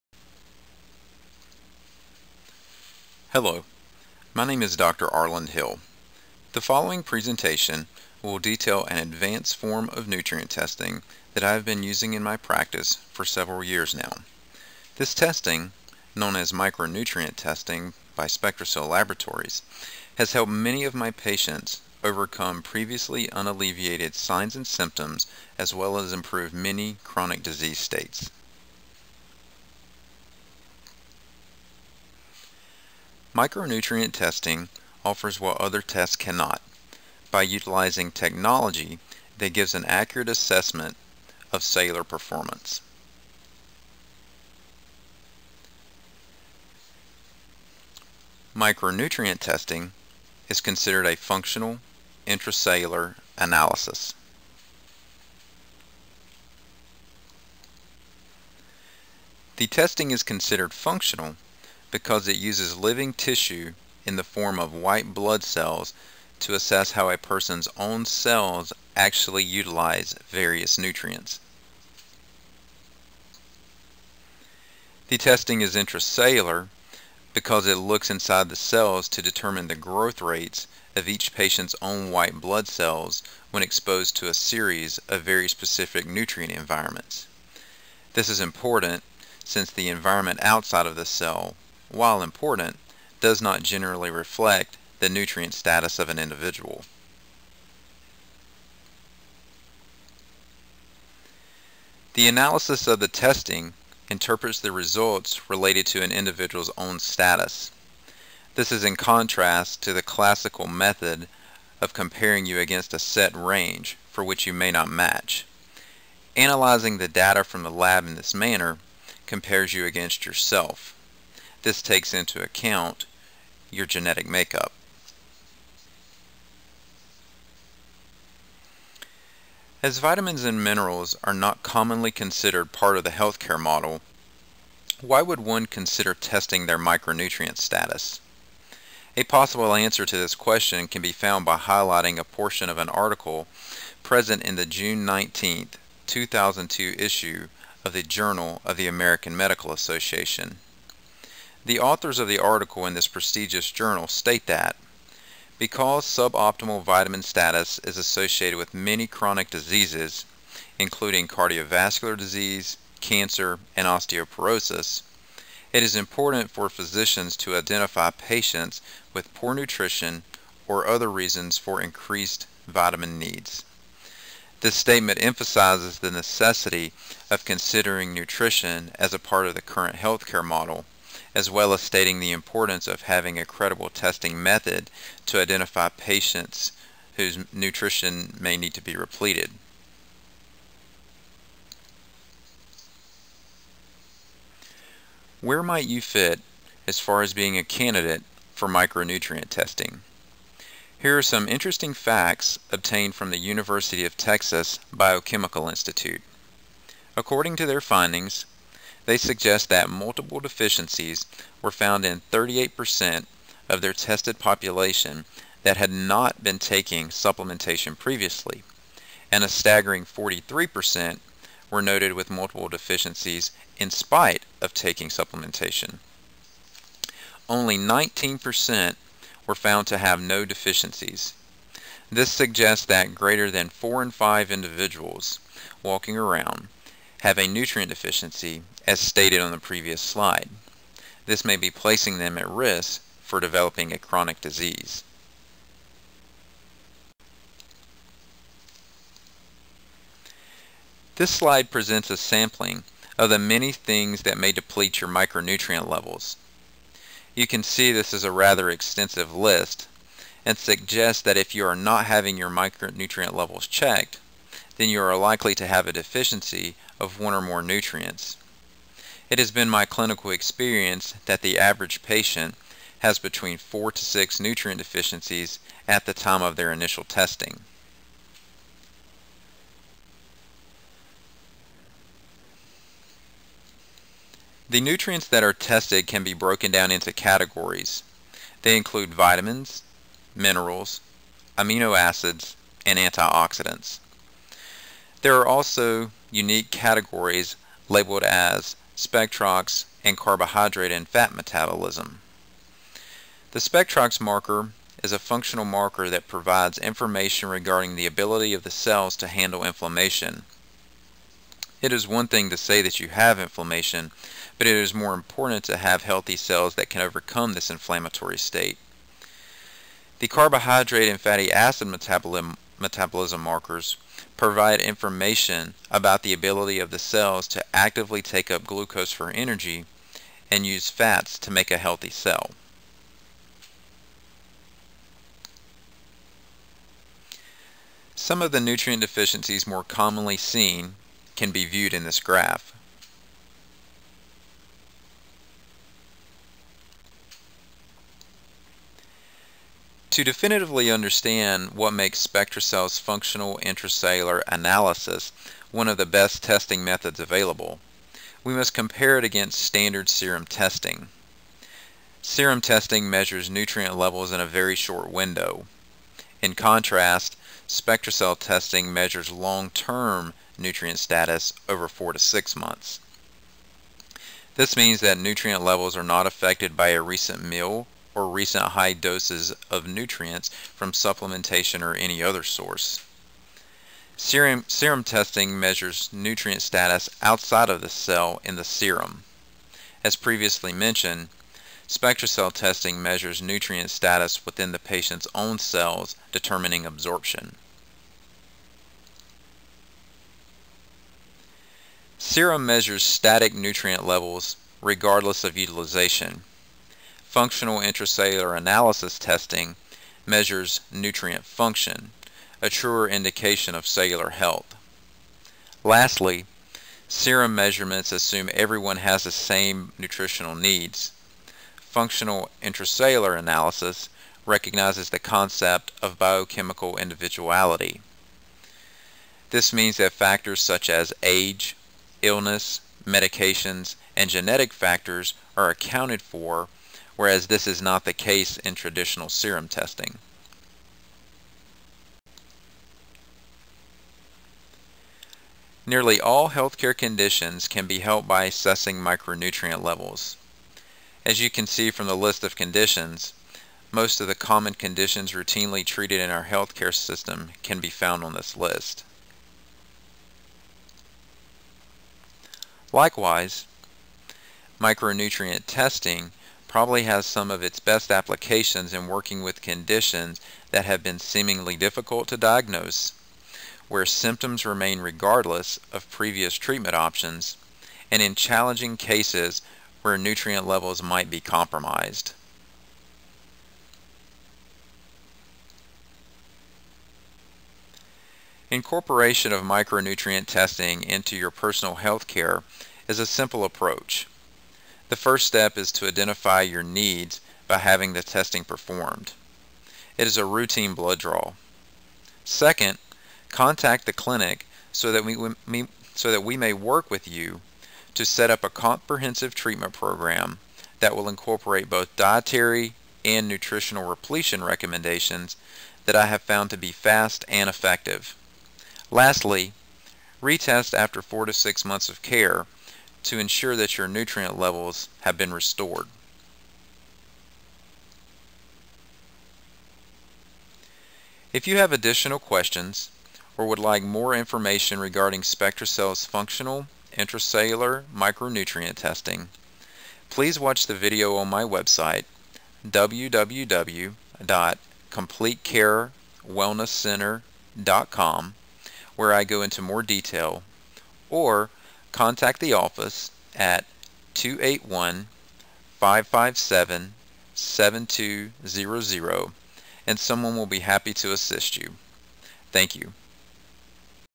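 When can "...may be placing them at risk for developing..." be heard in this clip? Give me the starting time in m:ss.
4:01.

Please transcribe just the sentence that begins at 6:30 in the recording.
As previously mentioned, SpectraCell testing measures nutrient status within the patient's own cells, determining absorption.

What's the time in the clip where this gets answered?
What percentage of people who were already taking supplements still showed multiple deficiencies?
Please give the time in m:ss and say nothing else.
3:40.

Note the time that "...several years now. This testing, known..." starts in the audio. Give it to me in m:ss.
0:13.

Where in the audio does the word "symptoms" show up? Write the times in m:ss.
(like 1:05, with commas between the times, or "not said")
0:24, 7:54.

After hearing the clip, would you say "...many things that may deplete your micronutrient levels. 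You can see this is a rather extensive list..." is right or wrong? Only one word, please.
right.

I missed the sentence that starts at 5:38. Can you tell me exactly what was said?
Some of the nutrient deficiencies more commonly seen can be viewed in this graph.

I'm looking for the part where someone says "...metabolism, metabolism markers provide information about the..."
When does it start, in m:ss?
5:21.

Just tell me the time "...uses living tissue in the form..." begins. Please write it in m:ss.
1:02.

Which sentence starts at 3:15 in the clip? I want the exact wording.
Where might you fit as far as being a candidate for micronutrient testing?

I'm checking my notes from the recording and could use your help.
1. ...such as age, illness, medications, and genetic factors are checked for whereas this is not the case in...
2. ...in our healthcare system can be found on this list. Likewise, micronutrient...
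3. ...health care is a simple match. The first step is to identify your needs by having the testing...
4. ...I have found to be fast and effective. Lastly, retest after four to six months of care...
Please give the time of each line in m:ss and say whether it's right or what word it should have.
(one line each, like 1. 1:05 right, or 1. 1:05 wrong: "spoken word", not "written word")
1. 7:10 wrong: "accounted", not "checked"
2. 7:36 right
3. 8:11 wrong: "approach", not "match"
4. 8:36 right.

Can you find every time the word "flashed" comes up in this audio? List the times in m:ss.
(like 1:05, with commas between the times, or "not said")
not said.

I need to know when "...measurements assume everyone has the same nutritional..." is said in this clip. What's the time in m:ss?
6:57.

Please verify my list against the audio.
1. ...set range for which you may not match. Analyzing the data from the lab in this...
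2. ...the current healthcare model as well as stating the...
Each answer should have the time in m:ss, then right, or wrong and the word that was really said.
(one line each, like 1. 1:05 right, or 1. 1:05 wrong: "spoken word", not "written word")
1. 1:52 right
2. 2:59 right.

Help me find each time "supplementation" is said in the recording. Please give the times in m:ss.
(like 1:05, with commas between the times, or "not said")
3:37, 3:45, 6:20.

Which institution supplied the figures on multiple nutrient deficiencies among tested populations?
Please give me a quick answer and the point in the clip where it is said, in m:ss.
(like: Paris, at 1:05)
University of Texas Biochemical Institute, at 3:23.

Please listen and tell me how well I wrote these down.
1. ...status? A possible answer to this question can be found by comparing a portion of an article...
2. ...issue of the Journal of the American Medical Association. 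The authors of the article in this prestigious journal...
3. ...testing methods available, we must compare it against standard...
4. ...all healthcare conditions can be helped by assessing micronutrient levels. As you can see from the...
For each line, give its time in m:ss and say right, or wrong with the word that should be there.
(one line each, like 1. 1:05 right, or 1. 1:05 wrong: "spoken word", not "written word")
1. 2:17 wrong: "highlighting", not "comparing"
2. 2:26 right
3. 5:56 right
4. 7:26 right.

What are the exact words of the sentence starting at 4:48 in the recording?
They include vitamins, minerals, amino acids, and antioxidants.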